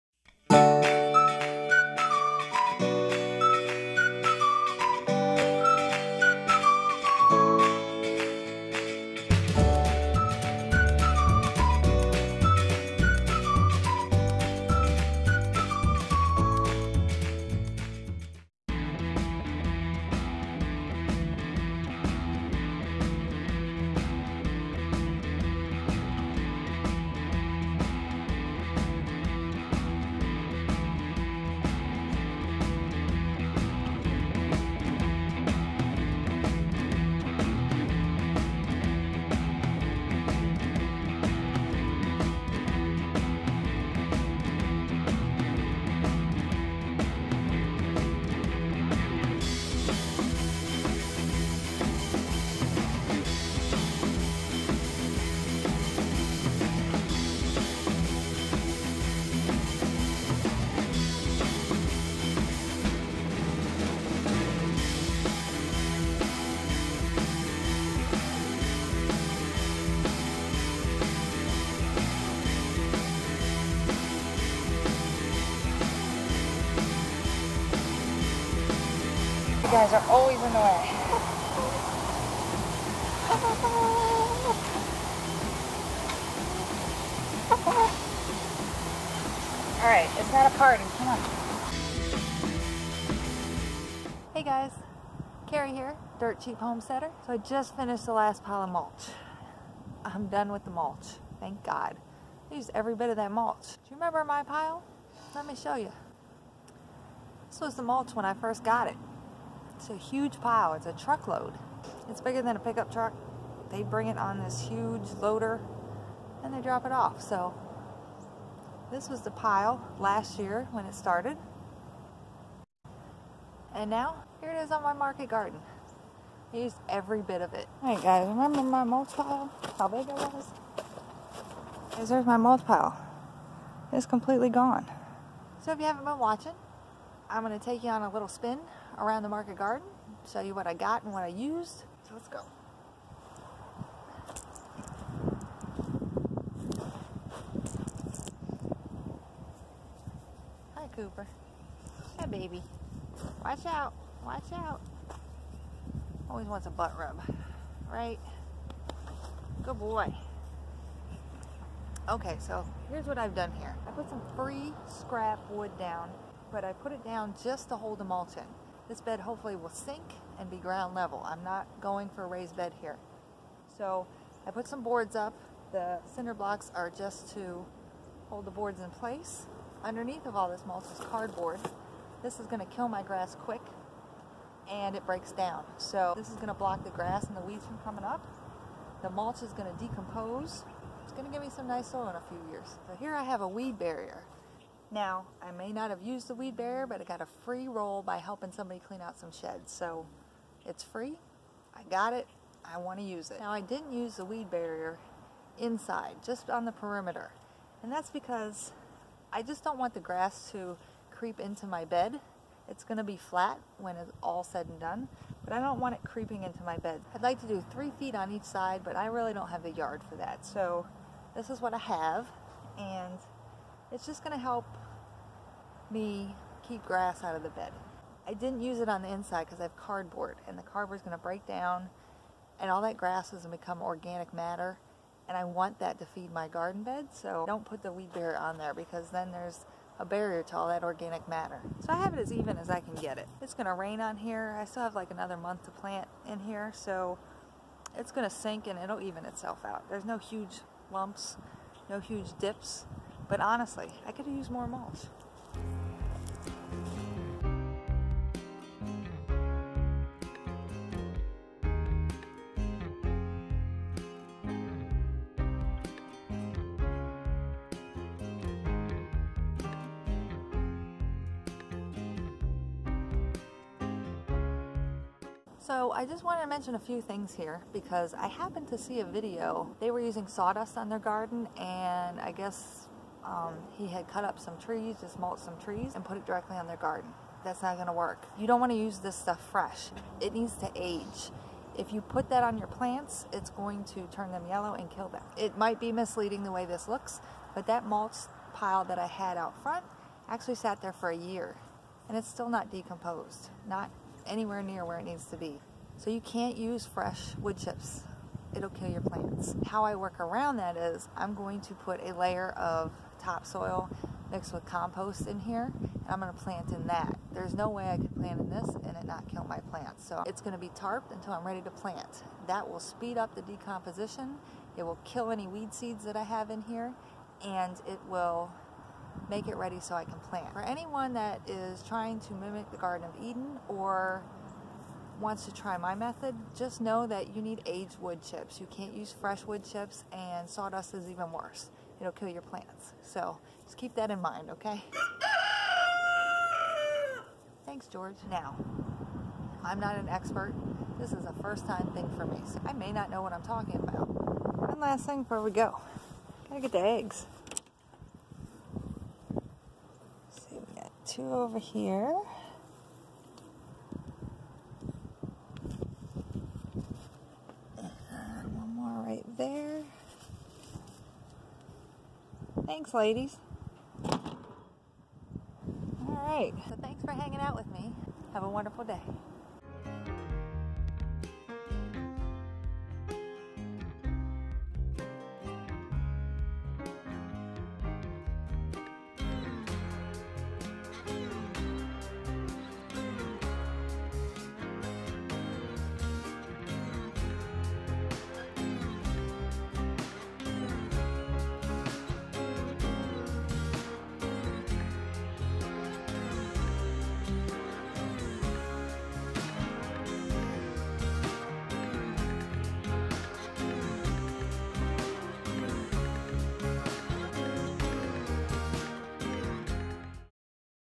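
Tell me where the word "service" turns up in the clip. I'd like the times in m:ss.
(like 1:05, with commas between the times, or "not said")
not said.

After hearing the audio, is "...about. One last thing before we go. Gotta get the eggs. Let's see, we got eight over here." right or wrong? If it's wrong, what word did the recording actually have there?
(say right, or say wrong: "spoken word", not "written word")
wrong: "two", not "eight".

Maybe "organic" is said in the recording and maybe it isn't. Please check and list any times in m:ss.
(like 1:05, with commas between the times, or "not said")
3:53, 4:00.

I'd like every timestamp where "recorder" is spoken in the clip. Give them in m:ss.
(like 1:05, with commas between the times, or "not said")
not said.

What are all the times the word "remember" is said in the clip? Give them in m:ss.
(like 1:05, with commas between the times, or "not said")
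1:43, 2:08.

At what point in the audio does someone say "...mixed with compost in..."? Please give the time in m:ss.
5:14.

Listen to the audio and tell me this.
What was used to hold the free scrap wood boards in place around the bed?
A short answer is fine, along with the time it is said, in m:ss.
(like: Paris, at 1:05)
Cinder blocks, at 2:56.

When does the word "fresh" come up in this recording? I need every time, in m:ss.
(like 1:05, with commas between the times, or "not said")
4:49, 5:06, 5:39.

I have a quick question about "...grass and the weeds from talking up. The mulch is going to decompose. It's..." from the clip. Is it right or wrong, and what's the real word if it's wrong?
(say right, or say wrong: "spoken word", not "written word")
wrong: "coming", not "talking".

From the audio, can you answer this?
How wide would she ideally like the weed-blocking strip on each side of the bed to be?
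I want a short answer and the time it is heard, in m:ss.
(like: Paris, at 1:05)
3 feet, at 3:37.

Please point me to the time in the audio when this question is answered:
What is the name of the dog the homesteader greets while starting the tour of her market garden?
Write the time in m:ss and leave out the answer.
2:30.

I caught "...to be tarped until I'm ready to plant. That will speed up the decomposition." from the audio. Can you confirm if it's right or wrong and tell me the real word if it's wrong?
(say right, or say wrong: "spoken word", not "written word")
right.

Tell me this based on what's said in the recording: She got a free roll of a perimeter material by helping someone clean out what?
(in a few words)
Sheds.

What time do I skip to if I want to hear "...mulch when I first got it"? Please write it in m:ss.
1:47.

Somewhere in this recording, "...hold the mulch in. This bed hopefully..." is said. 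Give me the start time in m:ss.
2:47.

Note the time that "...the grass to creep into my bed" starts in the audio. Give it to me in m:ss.
3:29.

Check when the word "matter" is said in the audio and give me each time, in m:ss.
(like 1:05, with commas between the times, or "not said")
3:54, 4:01.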